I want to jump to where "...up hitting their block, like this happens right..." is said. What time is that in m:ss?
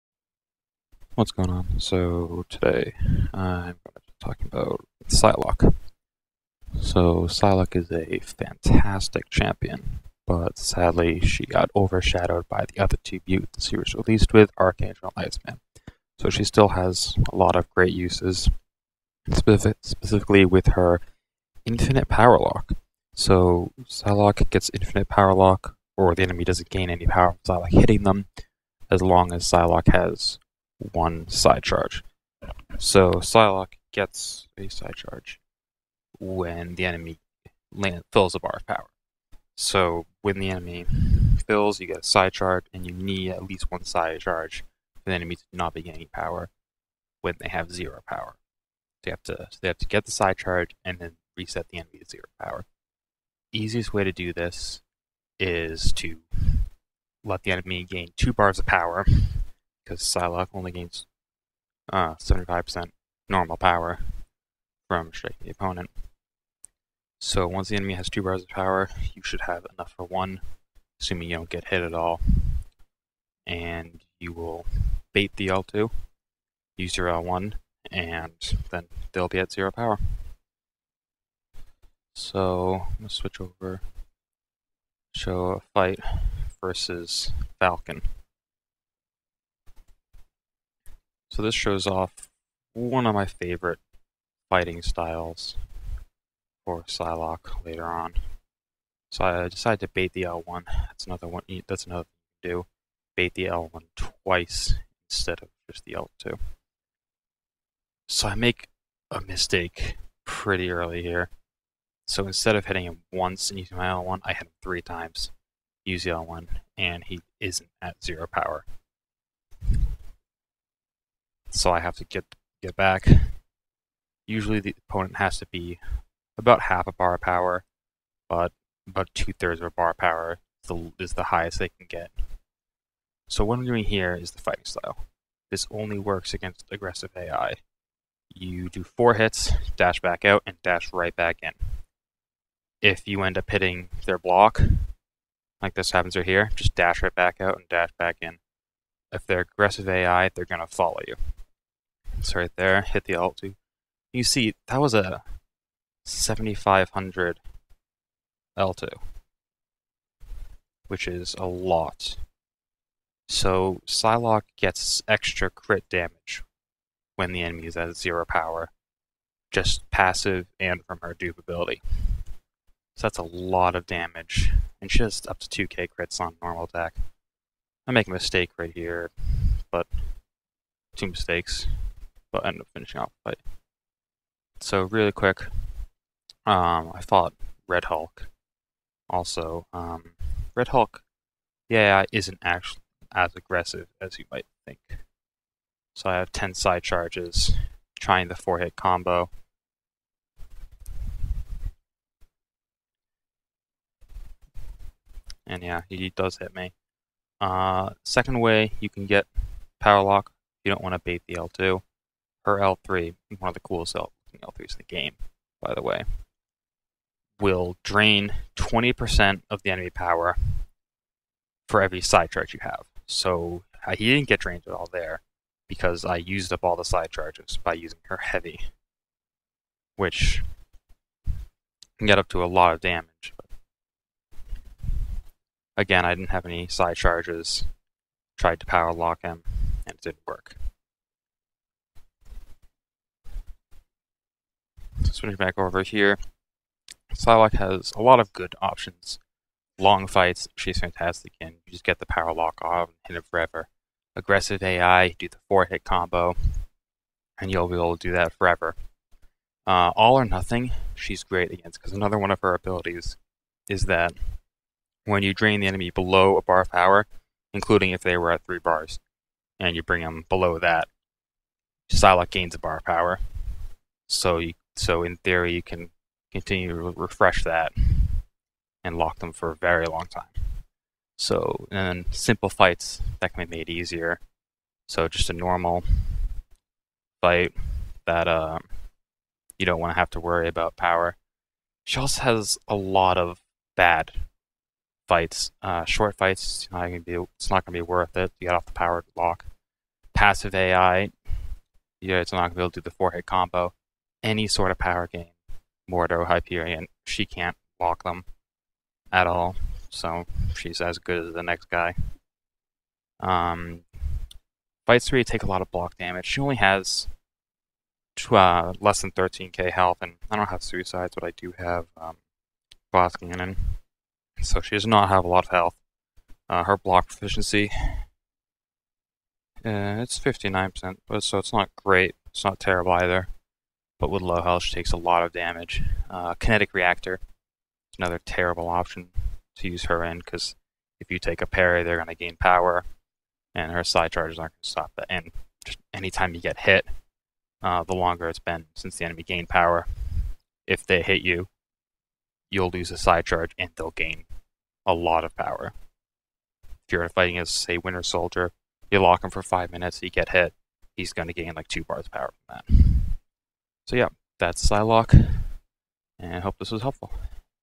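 2:23.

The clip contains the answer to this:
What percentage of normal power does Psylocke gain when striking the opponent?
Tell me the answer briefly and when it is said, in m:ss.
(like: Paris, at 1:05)
75%, at 1:02.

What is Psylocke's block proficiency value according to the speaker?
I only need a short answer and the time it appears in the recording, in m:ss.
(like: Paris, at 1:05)
59%, at 5:30.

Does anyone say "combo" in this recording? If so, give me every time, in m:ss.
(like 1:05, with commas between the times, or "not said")
3:18, 4:15, 5:03.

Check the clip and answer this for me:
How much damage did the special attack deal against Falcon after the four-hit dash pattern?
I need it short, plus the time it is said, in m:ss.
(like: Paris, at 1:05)
7500, at 2:36.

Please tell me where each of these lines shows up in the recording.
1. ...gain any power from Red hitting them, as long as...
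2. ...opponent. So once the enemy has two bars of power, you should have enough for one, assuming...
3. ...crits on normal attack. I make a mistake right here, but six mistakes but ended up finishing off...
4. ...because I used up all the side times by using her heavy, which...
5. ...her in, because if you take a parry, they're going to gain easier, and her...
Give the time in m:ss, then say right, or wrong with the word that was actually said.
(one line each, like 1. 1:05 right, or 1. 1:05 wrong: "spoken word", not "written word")
1. 0:26 wrong: "Psylocke", not "Red"
2. 1:05 right
3. 2:55 wrong: "two", not "six"
4. 3:45 wrong: "charges", not "times"
5. 5:39 wrong: "power", not "easier".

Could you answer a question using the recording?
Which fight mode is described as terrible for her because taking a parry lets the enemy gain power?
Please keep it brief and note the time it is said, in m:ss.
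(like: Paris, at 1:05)
Kinetic Reactor, at 5:36.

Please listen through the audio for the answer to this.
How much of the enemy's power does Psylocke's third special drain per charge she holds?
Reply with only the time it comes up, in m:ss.
3:38.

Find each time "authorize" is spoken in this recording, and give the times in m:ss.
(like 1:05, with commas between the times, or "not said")
not said.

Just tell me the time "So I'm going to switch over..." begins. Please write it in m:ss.
1:22.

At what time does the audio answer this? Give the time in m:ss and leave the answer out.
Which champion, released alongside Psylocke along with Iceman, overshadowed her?
0:14.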